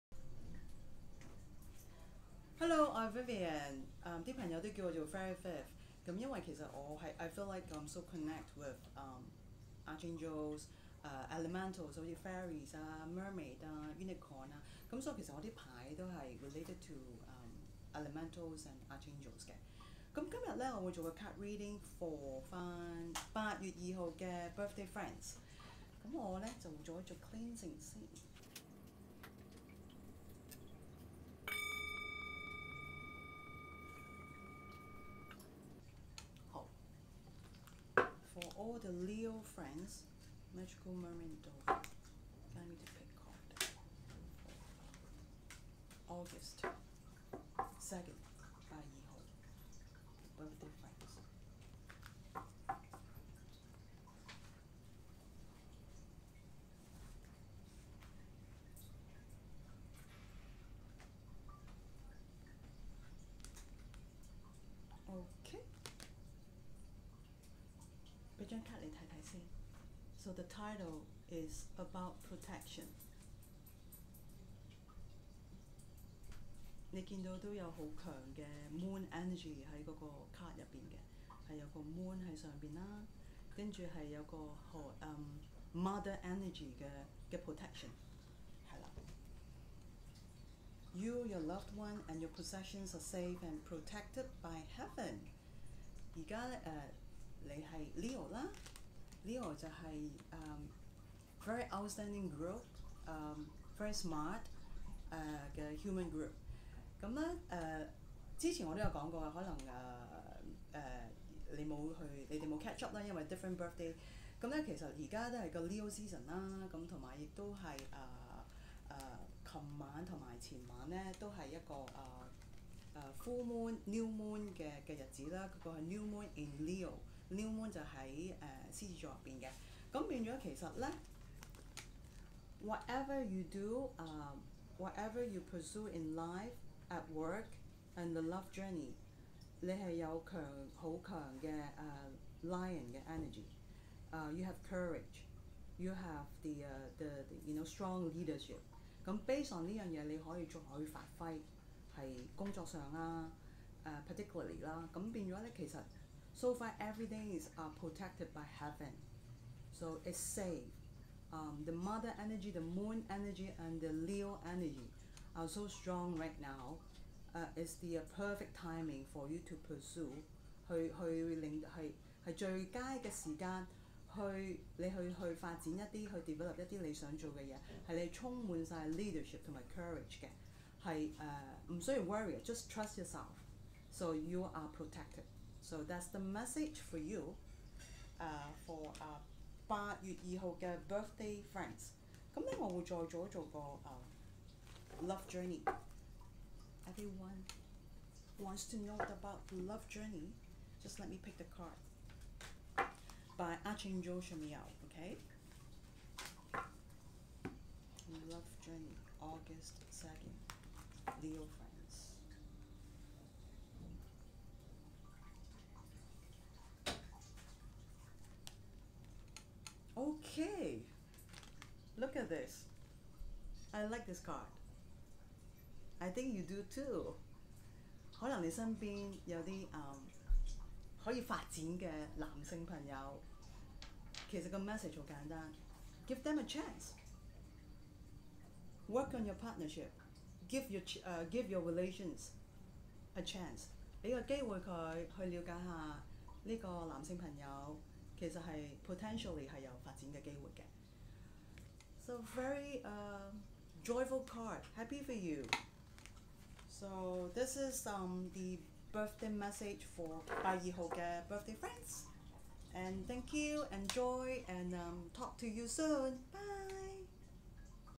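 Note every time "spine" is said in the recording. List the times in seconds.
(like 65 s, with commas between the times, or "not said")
not said.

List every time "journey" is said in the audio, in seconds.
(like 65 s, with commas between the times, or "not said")
138 s, 195 s, 199 s, 208 s.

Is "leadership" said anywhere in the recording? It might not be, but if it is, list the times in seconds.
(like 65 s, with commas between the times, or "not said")
148 s, 178 s.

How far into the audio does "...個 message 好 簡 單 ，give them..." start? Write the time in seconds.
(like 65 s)
234 s.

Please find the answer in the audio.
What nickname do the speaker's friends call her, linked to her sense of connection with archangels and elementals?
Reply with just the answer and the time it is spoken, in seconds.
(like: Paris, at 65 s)
Fairy Fifth, at 5 s.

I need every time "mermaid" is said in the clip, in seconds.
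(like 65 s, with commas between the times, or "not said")
13 s, 40 s.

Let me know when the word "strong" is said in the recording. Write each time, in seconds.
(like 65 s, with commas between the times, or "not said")
147 s, 165 s.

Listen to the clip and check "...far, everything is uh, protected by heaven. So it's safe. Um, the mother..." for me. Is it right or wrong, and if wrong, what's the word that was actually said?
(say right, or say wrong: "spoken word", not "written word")
right.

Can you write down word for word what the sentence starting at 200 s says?
Just let me pick the card by Archangel ah Shamiel.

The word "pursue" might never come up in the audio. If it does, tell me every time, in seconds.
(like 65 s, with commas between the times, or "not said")
135 s, 169 s.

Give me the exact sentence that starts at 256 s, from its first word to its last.
So this is um, the birthday message for 八 二 號 嘅 birthday friends.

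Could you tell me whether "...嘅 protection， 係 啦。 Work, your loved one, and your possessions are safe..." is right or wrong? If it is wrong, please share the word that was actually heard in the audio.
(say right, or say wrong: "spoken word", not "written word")
wrong: "You", not "Work".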